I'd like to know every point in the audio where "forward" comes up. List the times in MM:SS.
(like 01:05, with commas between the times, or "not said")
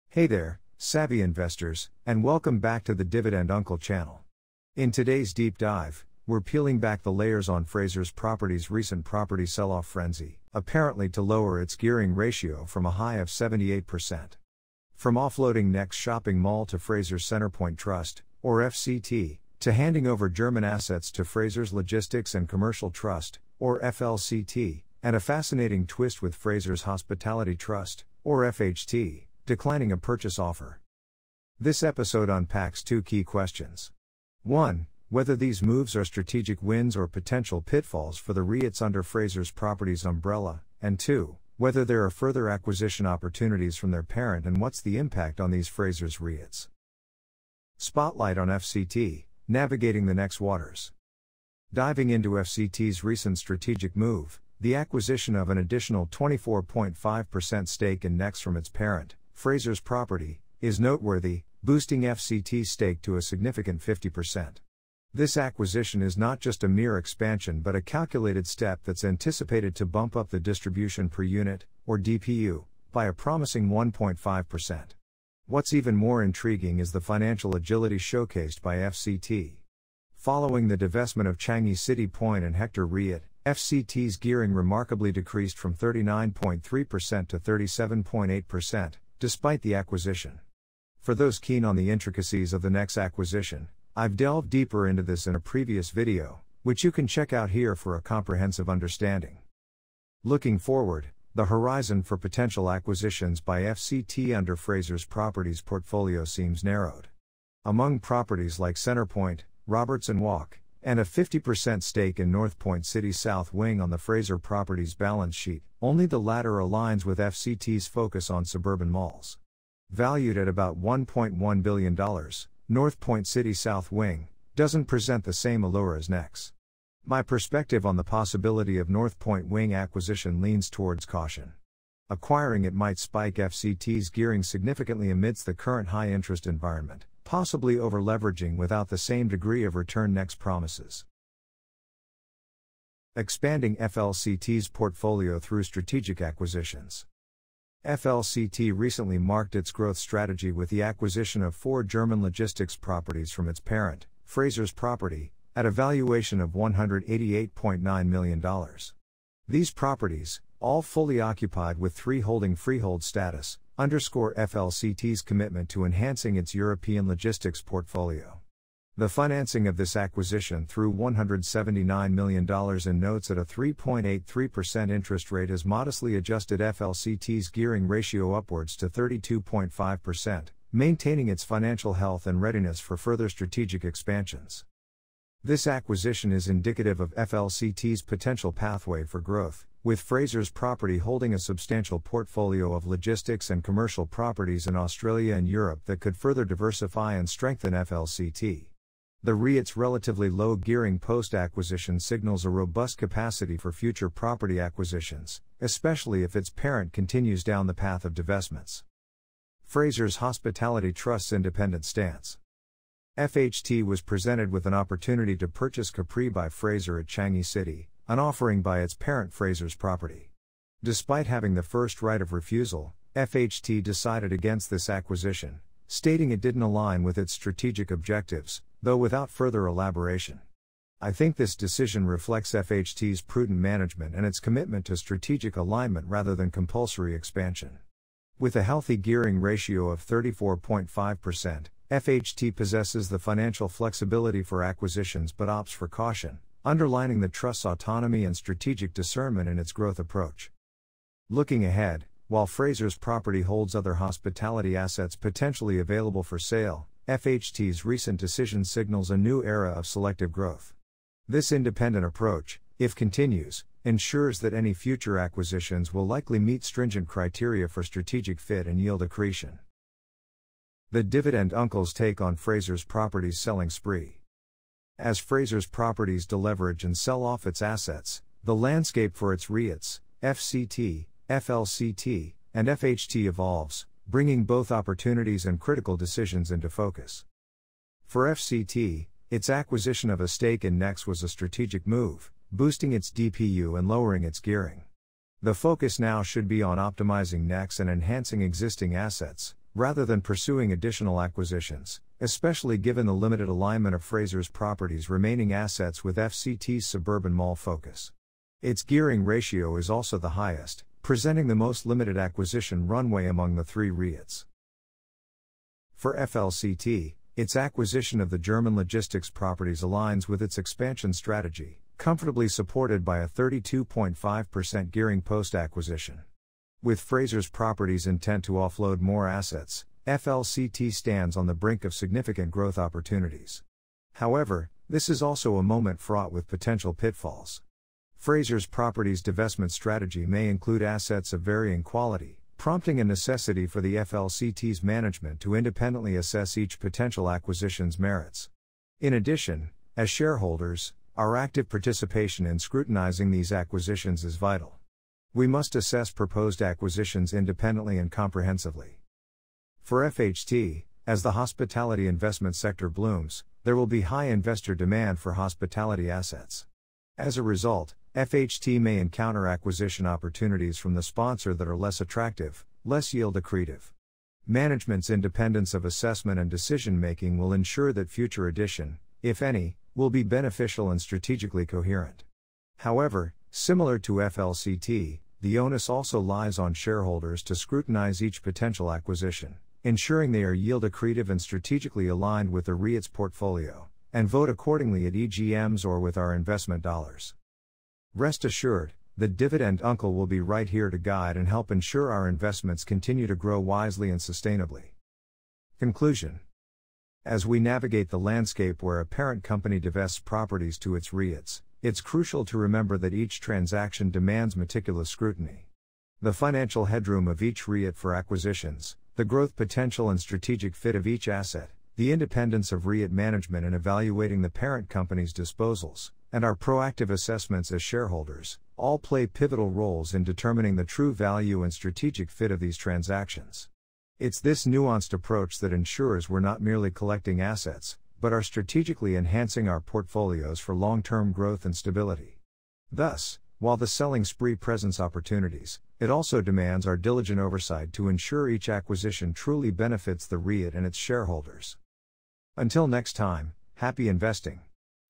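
01:40.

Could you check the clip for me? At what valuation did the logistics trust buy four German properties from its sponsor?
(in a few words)
$188.9 million.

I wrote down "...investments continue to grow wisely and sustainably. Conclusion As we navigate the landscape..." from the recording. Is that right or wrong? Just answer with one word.
right.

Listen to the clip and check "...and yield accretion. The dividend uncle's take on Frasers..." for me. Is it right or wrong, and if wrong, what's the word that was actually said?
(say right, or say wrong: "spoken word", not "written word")
right.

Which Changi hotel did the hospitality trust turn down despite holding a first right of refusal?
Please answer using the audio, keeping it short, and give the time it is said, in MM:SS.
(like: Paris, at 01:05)
Capri by Fraser, at 03:35.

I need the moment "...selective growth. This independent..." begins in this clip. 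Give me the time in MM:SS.
04:19.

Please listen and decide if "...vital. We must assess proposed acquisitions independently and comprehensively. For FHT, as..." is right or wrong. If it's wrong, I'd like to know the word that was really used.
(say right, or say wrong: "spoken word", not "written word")
right.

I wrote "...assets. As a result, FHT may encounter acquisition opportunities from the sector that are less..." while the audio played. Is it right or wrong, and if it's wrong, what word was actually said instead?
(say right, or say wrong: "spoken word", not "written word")
wrong: "sponsor", not "sector".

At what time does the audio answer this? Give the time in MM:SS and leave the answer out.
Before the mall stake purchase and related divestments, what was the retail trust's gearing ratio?
01:25.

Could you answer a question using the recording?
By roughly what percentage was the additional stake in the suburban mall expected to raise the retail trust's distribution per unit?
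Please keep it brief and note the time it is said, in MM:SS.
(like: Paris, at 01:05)
1.5%, at 01:13.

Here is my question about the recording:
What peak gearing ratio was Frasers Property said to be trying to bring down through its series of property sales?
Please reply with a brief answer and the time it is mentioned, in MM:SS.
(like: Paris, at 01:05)
78%, at 00:13.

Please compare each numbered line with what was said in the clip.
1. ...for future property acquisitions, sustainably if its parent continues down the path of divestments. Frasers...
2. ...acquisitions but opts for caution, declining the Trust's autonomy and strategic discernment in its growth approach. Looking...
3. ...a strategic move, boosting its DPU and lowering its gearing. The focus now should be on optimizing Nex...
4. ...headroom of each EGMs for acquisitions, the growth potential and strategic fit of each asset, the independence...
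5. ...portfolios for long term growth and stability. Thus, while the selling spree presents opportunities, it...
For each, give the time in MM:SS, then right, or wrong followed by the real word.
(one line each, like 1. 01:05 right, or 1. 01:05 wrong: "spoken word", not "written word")
1. 03:23 wrong: "especially", not "sustainably"
2. 04:04 wrong: "underlining", not "declining"
3. 04:51 right
4. 06:56 wrong: "REIT", not "EGMs"
5. 07:19 right.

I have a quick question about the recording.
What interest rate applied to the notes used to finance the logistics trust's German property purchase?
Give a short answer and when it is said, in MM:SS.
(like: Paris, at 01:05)
3.83%, at 02:53.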